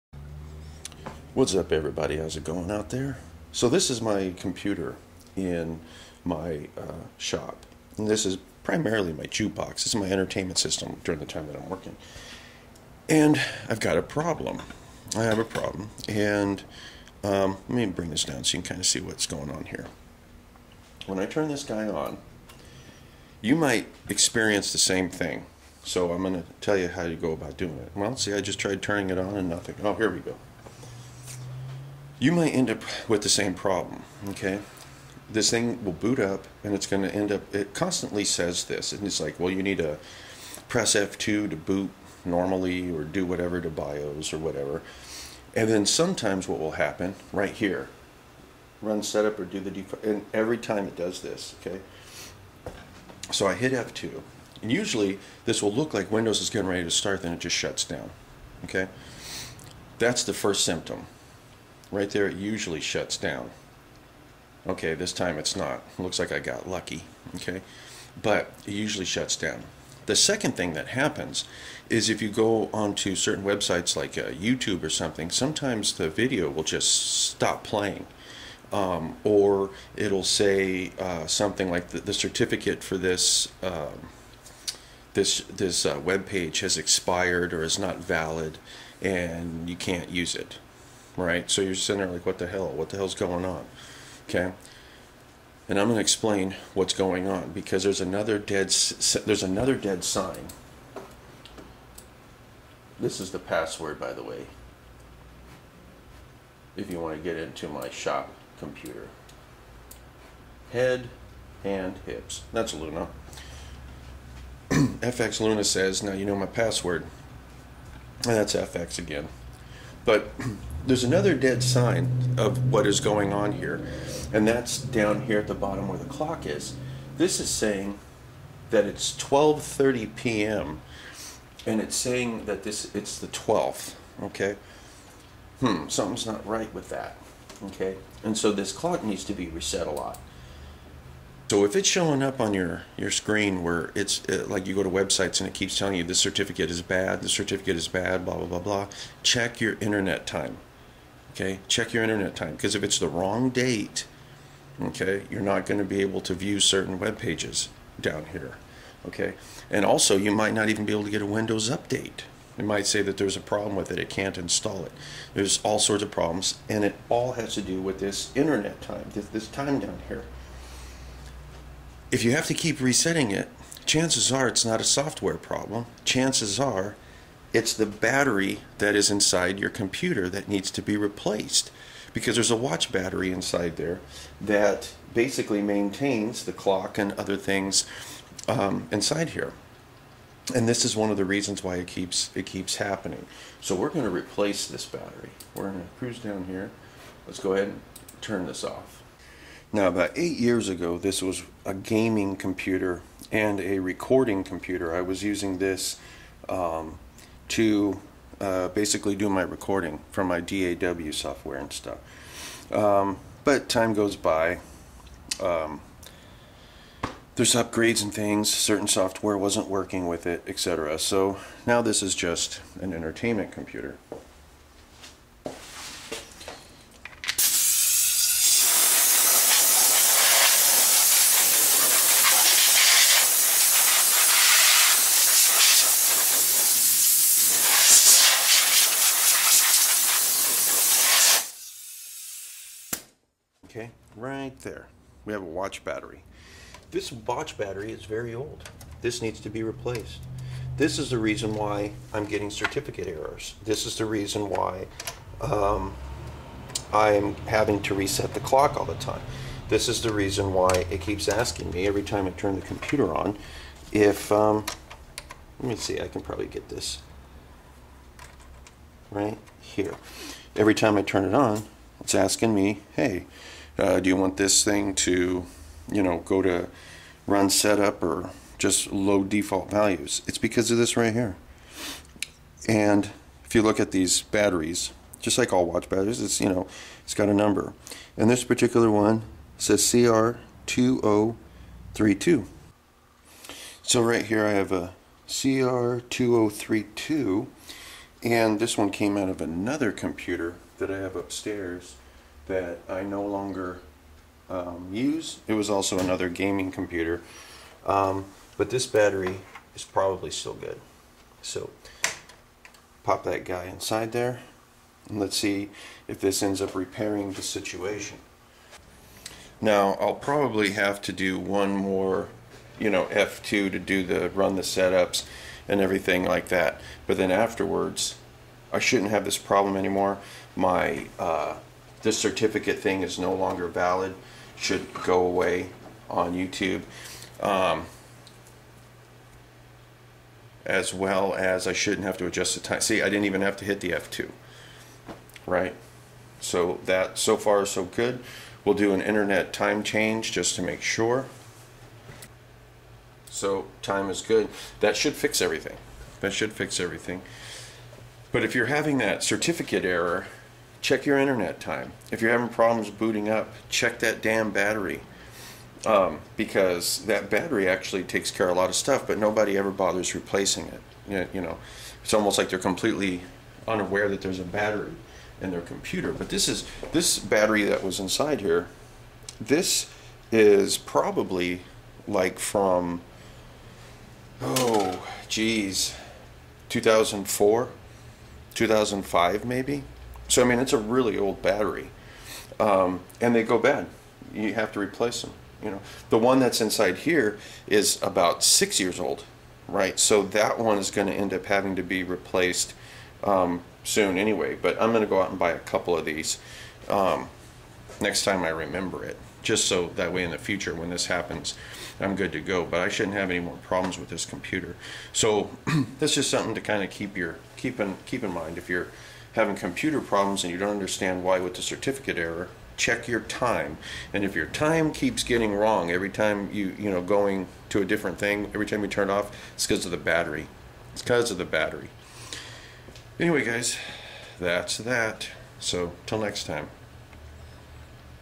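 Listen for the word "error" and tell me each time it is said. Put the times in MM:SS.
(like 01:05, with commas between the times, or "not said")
04:13, 05:59, 07:02.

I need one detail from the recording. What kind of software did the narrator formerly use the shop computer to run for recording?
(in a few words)
DAW software.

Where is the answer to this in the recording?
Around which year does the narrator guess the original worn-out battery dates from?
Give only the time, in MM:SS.
06:26.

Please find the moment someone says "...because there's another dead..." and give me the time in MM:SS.
01:37.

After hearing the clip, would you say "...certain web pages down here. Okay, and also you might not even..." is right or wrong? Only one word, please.
right.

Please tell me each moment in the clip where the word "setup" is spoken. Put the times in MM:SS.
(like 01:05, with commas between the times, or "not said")
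00:49, 04:37, 05:24.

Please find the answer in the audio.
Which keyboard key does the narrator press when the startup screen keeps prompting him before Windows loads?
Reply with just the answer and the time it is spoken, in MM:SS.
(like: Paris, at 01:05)
F2, at 00:53.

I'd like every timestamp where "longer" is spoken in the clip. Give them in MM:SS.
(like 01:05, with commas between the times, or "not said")
05:03, 05:33.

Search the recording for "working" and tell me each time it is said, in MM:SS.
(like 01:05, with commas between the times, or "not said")
00:11, 03:39.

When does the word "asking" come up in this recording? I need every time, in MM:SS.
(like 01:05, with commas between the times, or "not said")
04:21, 04:32.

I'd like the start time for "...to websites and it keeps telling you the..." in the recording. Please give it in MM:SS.
02:24.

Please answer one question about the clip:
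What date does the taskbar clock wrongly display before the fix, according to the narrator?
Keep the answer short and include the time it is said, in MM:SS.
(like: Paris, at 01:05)
the 12th, at 02:12.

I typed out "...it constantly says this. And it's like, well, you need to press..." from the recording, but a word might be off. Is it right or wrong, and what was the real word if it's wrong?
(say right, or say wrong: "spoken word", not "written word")
right.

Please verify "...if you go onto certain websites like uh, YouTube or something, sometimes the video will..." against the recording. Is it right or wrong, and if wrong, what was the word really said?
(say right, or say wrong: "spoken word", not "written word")
right.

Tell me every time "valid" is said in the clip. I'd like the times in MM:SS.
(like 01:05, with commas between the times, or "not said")
01:27, 05:33.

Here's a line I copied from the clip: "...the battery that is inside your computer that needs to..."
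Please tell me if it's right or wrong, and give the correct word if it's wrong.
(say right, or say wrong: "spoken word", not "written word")
right.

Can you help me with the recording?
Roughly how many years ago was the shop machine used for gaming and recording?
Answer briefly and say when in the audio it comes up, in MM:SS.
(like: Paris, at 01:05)
8, at 03:19.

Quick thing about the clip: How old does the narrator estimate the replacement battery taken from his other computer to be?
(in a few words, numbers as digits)
6 years.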